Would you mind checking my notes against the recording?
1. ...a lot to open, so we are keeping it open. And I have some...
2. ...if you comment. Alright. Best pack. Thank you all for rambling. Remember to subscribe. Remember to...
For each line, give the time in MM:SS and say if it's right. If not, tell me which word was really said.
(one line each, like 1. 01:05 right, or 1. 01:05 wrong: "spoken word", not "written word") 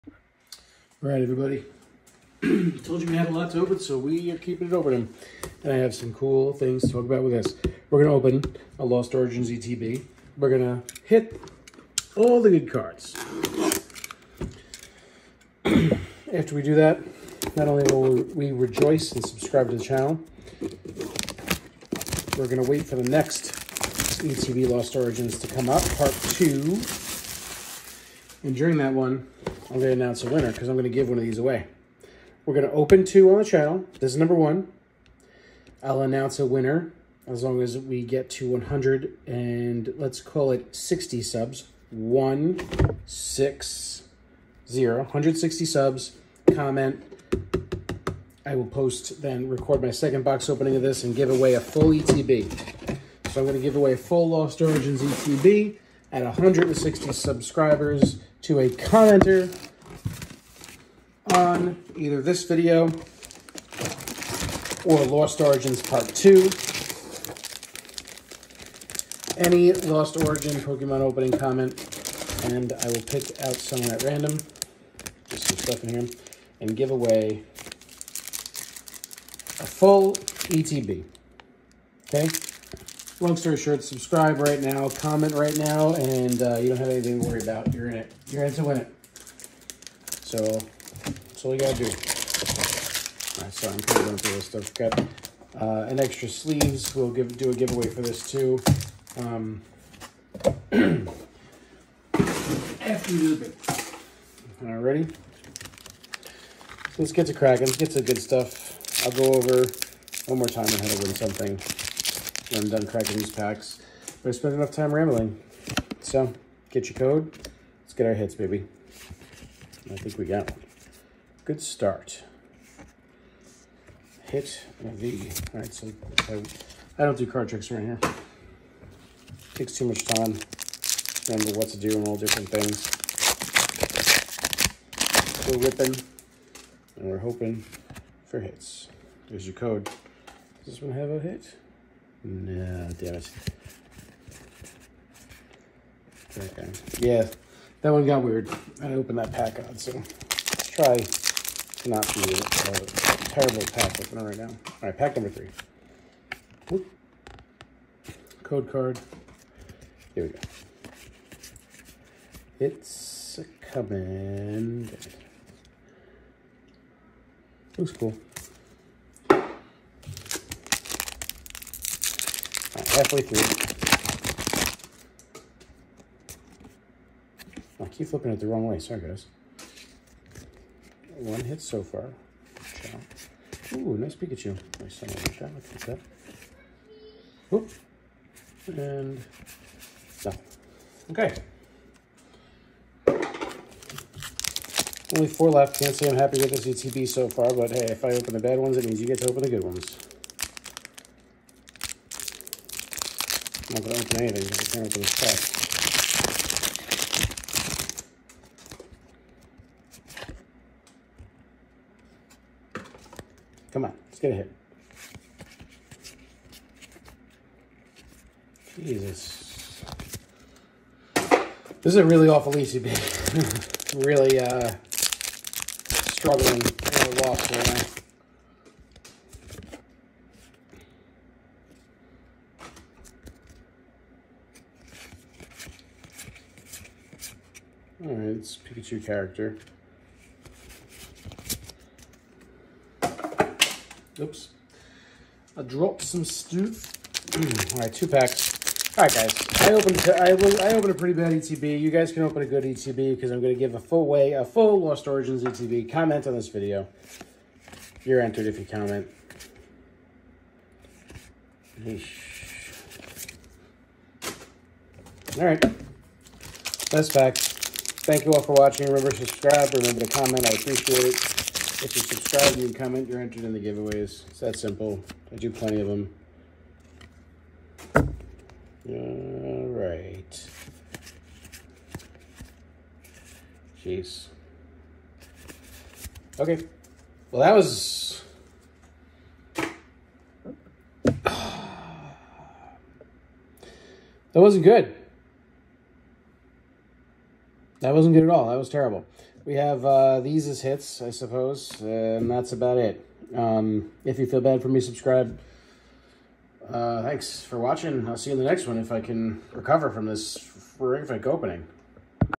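1. 00:03 right
2. 04:18 wrong: "watching", not "rambling".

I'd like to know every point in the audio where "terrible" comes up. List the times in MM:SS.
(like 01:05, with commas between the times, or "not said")
02:33, 04:58.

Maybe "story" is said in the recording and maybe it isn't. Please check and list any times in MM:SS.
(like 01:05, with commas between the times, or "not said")
01:23.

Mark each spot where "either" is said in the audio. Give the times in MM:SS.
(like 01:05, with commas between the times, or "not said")
01:01.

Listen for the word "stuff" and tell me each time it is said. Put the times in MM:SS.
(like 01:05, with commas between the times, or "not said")
01:15, 01:34, 01:48.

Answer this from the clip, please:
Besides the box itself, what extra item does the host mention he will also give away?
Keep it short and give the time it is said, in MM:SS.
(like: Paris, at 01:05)
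sleeves, at 01:36.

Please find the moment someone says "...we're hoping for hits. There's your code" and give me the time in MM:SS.
02:17.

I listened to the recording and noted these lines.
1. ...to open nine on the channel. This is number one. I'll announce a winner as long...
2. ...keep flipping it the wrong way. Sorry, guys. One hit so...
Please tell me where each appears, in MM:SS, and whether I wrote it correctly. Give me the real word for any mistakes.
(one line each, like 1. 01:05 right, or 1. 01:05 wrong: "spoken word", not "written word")
1. 00:32 wrong: "two", not "nine"
2. 02:57 right.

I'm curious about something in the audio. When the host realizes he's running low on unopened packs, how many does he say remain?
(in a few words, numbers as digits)
4.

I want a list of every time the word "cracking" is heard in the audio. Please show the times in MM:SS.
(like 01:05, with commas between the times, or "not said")
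01:47, 01:52.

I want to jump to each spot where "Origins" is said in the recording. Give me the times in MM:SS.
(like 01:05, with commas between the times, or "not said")
00:09, 00:24, 00:54, 01:05, 01:10, 04:15.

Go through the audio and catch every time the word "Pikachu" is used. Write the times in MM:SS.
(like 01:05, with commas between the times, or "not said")
03:04, 03:58.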